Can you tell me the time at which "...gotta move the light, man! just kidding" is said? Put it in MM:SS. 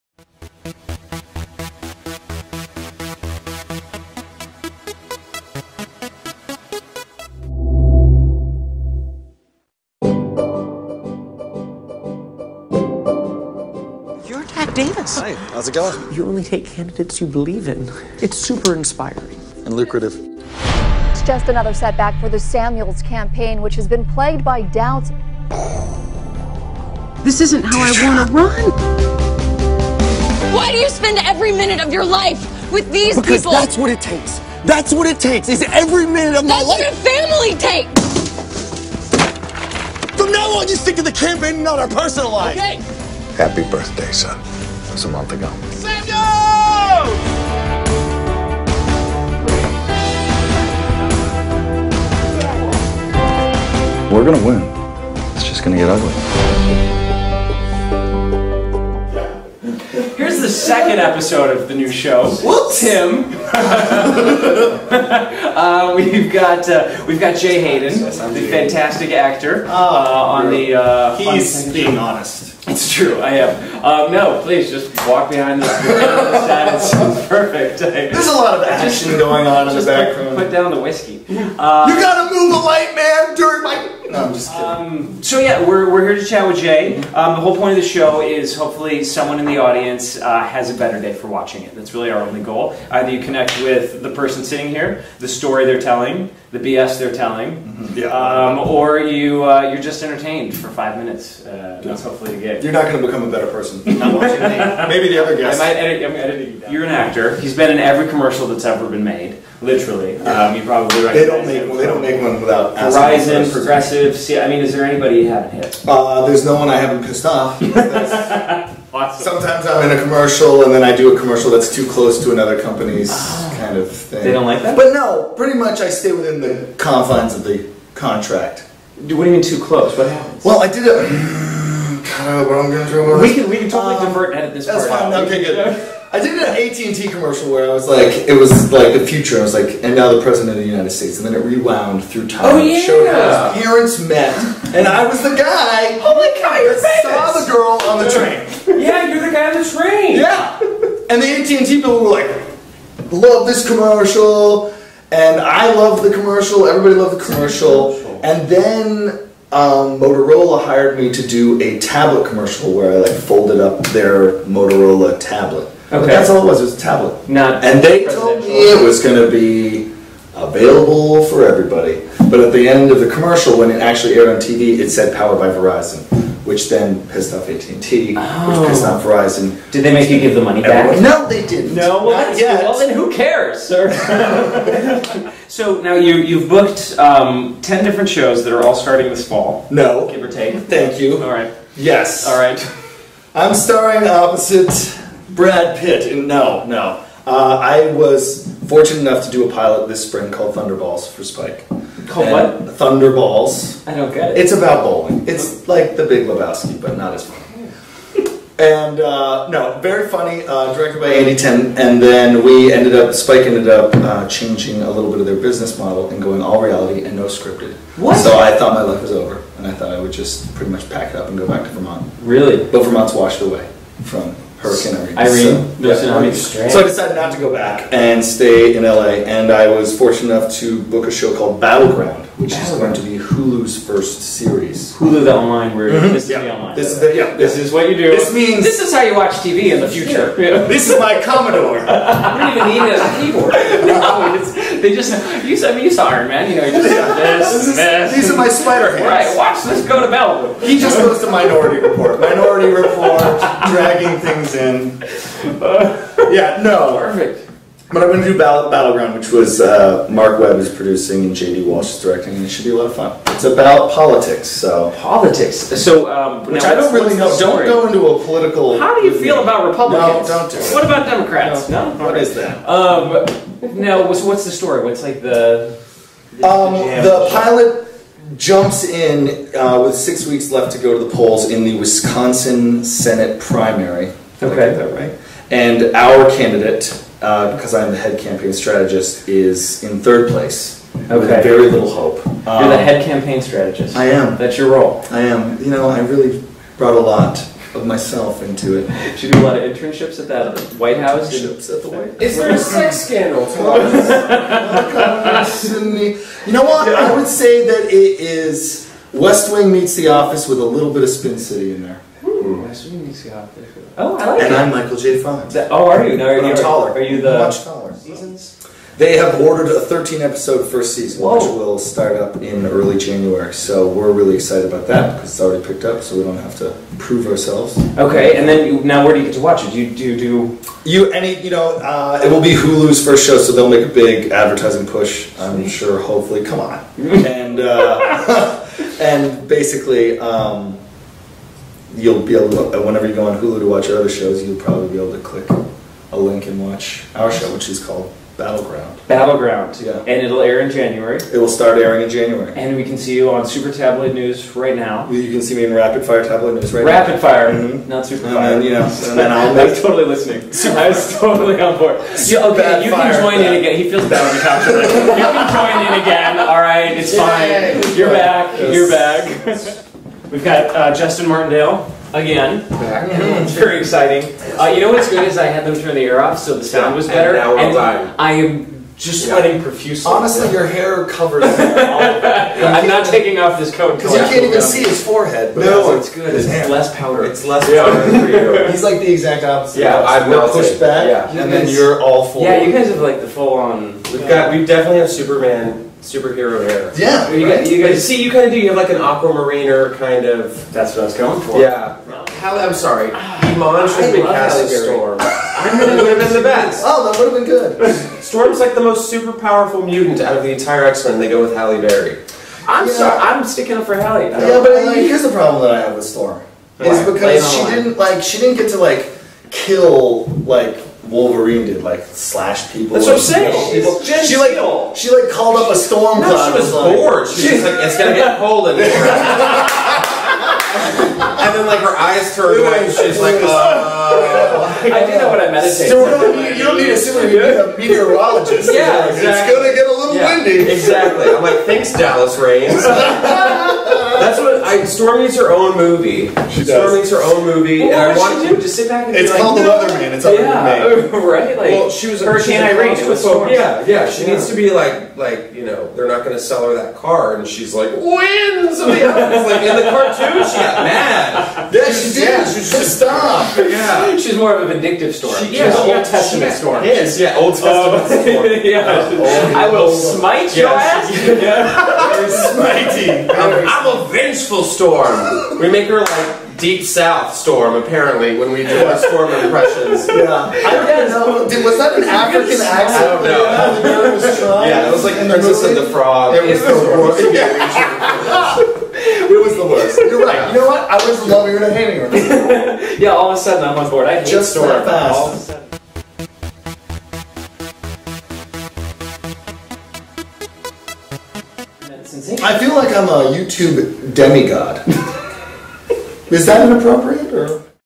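01:21.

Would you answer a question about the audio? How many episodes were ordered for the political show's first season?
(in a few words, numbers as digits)
13.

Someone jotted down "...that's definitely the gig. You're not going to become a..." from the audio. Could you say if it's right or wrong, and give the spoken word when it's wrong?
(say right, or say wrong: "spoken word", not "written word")
wrong: "hopefully", not "definitely".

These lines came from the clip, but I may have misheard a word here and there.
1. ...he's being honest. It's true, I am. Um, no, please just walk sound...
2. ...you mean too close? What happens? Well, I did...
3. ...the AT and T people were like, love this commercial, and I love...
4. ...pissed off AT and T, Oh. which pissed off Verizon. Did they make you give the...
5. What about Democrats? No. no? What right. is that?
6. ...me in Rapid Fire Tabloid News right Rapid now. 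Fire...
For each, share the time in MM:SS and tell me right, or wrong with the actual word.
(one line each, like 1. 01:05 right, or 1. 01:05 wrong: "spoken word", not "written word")
1. 01:11 wrong: "behind", not "sound"
2. 02:09 right
3. 02:31 right
4. 02:57 right
5. 04:30 right
6. 05:55 right.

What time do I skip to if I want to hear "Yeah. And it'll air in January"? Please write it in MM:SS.
05:49.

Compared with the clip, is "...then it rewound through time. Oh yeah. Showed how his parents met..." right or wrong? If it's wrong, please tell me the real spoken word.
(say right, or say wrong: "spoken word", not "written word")
right.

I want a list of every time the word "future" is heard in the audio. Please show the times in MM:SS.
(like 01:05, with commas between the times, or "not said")
02:19, 03:59.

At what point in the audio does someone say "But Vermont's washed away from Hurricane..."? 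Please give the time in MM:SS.
03:42.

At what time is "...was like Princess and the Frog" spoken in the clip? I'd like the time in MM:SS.
08:04.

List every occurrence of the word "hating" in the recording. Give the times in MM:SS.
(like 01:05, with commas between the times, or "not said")
08:11.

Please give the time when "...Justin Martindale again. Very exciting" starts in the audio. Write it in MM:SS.
06:10.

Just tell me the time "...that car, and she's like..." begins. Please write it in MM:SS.
07:36.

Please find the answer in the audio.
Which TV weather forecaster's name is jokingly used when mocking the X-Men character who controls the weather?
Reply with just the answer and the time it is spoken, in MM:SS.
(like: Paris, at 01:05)
Dallas Raines, at 07:21.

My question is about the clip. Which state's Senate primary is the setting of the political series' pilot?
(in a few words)
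Wisconsin.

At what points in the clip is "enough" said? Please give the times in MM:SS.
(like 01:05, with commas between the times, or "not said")
03:19, 03:50.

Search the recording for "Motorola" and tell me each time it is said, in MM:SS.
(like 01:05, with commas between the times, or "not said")
02:39, 02:44.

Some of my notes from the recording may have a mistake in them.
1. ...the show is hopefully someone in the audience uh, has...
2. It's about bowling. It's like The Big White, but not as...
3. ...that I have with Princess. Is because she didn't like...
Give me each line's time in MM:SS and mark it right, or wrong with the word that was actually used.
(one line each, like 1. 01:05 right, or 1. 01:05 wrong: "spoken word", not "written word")
1. 01:27 right
2. 03:24 wrong: "Lebowski", not "White"
3. 06:55 wrong: "Storm", not "Princess".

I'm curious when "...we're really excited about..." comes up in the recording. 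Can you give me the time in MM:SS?
05:23.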